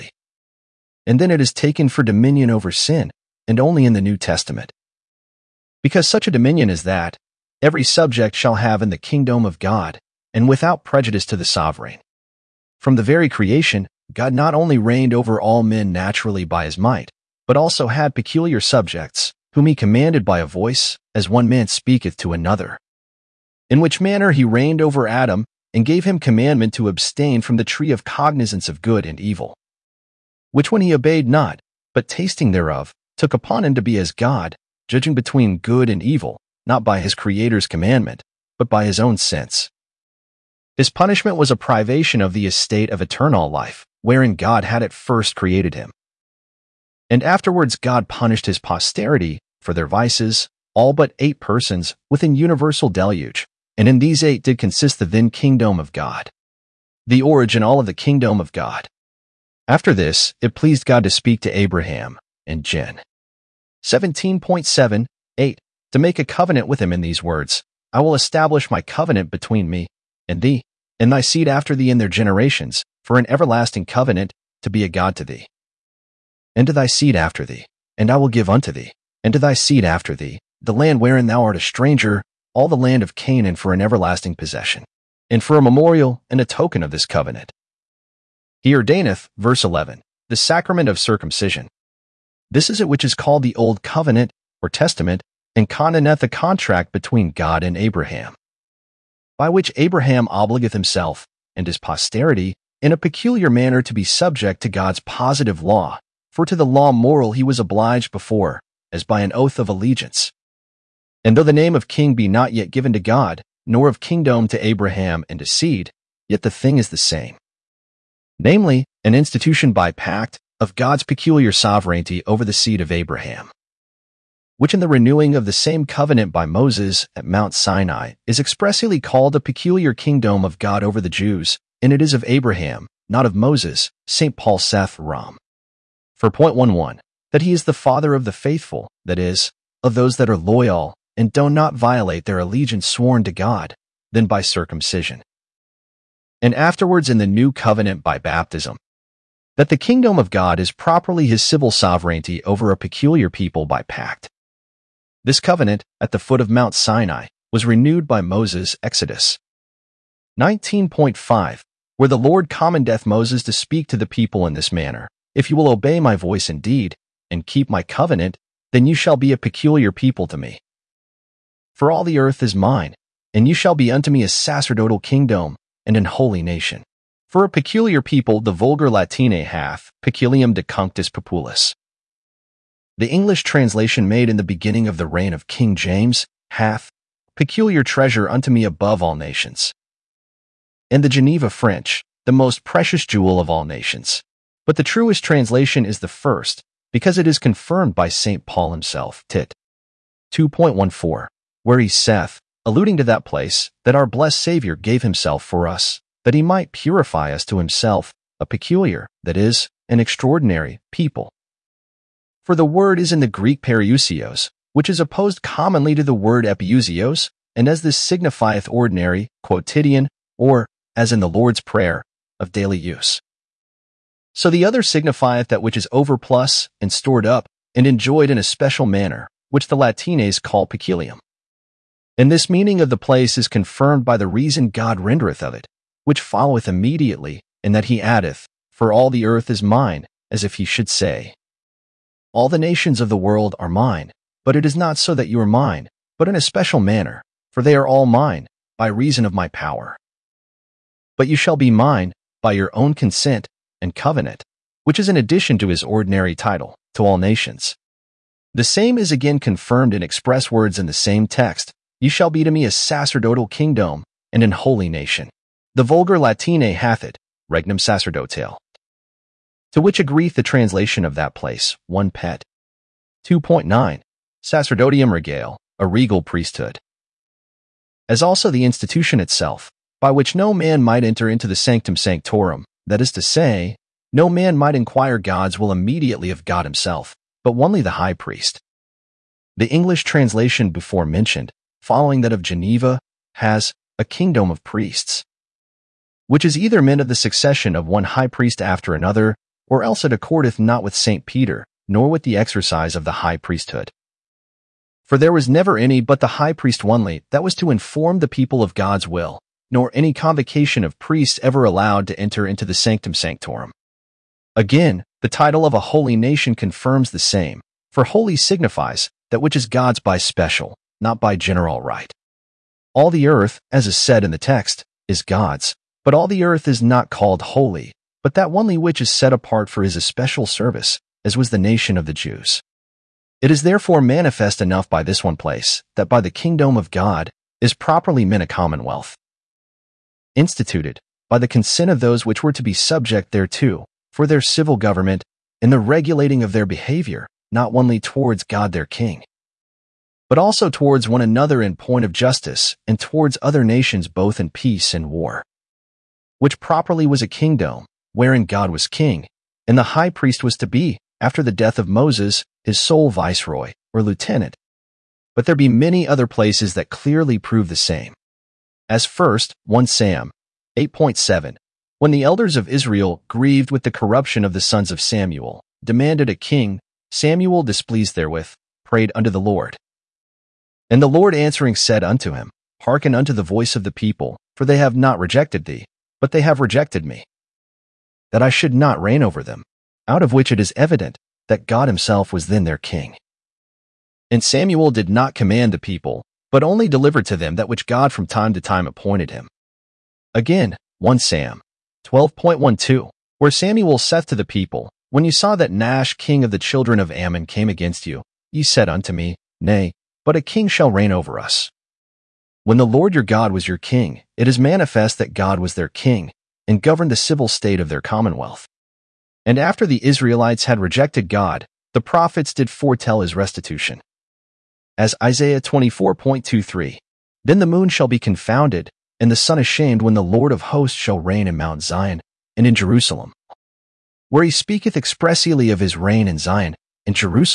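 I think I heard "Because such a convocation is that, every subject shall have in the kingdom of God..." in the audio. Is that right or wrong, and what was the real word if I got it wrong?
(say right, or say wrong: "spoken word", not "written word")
wrong: "dominion", not "convocation".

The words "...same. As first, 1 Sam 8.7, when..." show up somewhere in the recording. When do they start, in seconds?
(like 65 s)
367 s.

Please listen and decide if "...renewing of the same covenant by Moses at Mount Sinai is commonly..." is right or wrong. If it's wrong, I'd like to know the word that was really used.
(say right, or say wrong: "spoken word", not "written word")
wrong: "expressly", not "commonly".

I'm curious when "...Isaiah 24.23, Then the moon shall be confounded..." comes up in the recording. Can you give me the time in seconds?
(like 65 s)
425 s.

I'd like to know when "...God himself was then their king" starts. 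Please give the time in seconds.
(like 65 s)
391 s.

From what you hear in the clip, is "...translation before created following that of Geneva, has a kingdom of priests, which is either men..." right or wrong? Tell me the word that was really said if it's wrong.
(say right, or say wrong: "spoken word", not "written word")
wrong: "mentioned", not "created".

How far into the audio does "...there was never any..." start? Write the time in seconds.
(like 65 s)
305 s.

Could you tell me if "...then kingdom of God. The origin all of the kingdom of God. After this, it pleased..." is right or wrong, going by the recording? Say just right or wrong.
right.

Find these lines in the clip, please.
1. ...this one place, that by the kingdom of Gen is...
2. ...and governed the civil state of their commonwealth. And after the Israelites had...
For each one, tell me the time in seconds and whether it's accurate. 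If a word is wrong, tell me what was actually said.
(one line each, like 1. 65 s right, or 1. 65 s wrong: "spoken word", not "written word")
1. 335 s wrong: "God", not "Gen"
2. 416 s right.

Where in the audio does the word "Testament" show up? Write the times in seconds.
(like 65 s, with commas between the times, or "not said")
4 s, 94 s.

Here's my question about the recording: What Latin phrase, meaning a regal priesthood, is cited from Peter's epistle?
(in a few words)
Sacerdotium regale.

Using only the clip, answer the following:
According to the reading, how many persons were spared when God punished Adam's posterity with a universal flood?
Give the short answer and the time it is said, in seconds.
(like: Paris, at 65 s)
8, at 51 s.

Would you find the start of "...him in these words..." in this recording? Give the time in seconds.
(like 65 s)
66 s.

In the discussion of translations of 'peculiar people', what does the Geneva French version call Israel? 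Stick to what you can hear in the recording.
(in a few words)
The most precious jewel of all nations.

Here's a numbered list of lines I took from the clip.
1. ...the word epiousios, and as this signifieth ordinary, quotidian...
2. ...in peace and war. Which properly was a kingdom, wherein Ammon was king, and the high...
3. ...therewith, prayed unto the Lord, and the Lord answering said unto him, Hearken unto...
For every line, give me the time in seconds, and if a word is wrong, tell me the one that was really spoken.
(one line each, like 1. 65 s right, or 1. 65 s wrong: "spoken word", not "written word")
1. 216 s right
2. 354 s wrong: "God", not "Ammon"
3. 378 s right.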